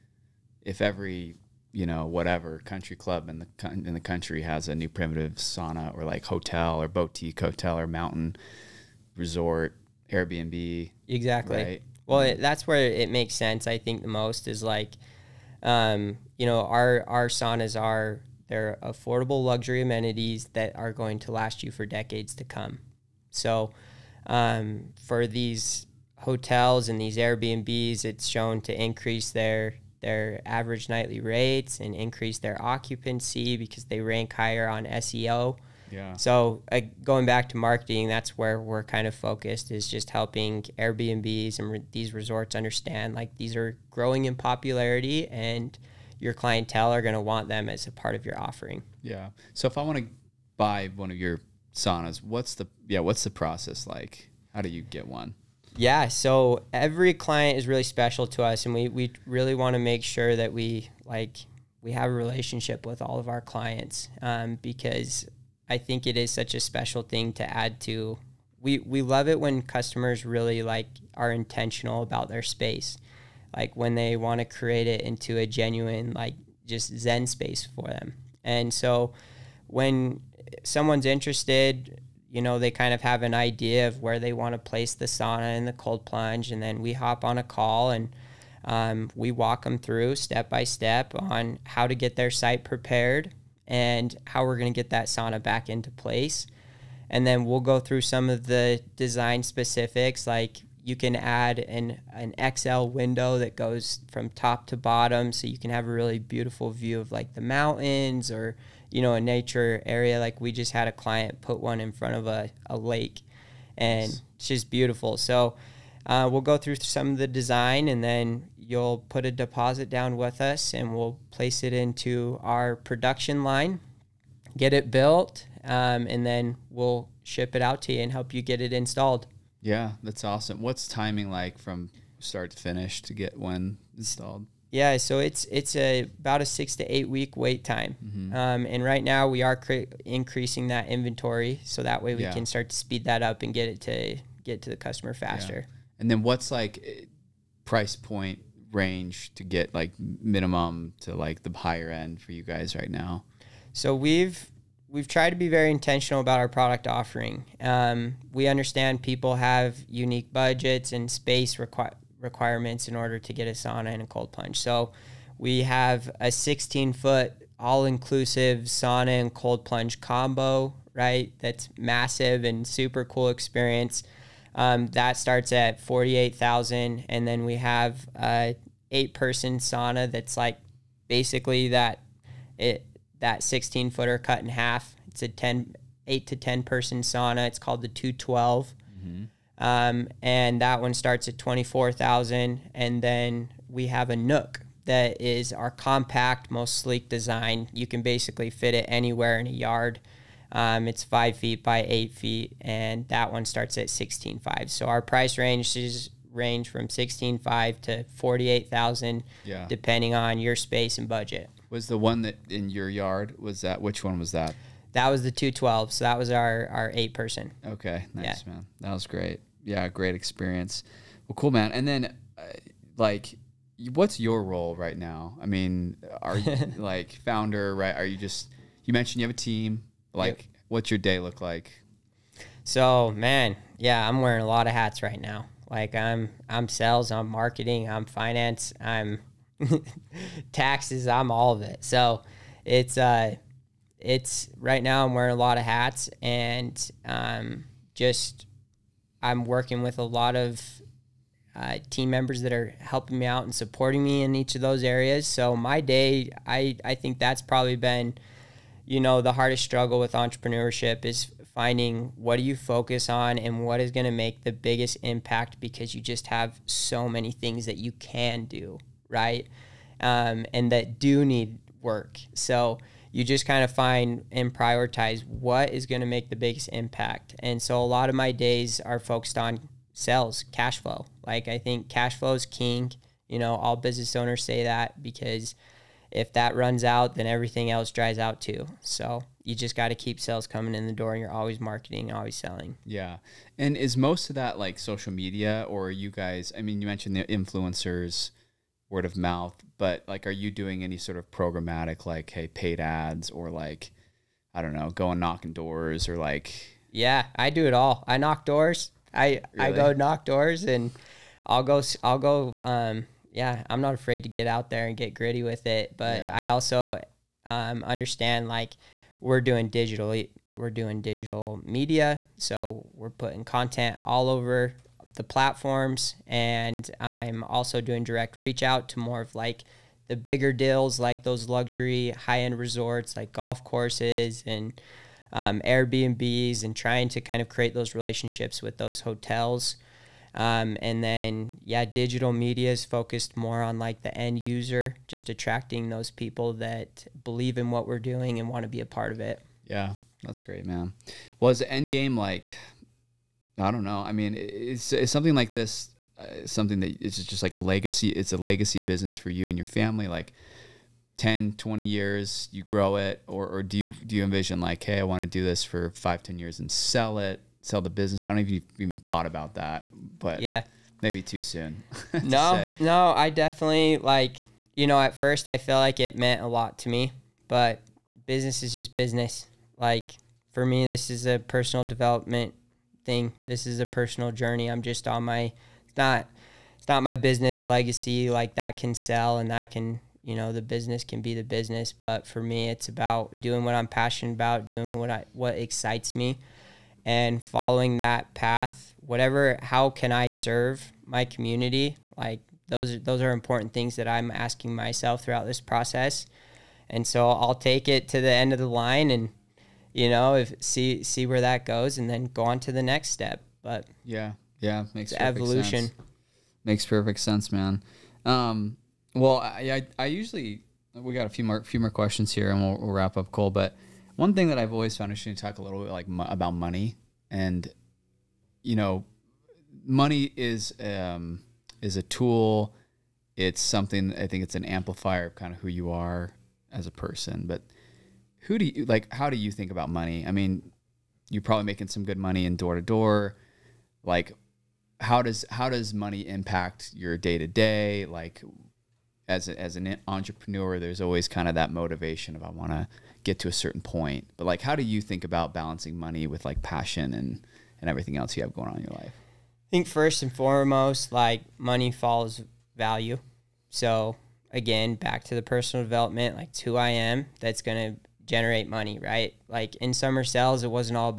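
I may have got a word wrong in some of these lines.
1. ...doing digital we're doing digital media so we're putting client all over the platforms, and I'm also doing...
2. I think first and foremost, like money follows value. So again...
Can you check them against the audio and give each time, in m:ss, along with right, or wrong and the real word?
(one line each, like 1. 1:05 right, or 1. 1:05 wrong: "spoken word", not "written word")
1. 5:19 wrong: "content", not "client"
2. 7:39 right.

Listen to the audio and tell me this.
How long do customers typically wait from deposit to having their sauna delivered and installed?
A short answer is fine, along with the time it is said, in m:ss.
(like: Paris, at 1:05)
6 to 8 weeks, at 2:16.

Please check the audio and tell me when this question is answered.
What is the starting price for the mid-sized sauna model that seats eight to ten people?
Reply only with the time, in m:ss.
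3:11.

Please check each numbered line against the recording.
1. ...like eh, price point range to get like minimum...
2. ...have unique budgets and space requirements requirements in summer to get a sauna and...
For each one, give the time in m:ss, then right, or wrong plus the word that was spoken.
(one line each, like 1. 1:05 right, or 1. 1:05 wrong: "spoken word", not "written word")
1. 2:26 right
2. 2:39 wrong: "order", not "summer".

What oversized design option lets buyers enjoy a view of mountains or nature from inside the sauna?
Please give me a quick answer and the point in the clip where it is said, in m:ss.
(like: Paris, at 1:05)
XL window, at 1:42.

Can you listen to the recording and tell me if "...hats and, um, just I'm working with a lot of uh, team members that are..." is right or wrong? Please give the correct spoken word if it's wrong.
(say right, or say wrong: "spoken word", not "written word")
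right.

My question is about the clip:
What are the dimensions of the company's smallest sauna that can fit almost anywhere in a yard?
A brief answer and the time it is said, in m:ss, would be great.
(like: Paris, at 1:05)
5 feet by 8 feet, at 3:21.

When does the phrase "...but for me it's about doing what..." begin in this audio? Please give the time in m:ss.
6:31.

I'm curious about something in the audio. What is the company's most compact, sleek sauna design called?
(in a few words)
Nook.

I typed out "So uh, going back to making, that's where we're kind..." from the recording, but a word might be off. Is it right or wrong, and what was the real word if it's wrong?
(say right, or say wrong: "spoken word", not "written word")
wrong: "marketing", not "making".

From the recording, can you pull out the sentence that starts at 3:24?
So our price ranges range from sixteen five to forty eight thousand, yeah.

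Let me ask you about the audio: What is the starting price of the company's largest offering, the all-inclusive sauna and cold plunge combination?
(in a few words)
$48,000.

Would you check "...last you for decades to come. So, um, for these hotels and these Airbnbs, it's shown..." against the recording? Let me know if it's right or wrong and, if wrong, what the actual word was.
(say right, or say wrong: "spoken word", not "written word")
right.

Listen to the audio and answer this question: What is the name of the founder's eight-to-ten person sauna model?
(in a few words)
The 212.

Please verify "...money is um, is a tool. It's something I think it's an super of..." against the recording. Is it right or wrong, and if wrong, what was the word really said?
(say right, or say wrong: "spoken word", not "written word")
wrong: "amplifier", not "super".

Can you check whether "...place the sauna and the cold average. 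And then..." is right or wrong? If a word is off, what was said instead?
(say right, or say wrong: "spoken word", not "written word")
wrong: "plunge", not "average".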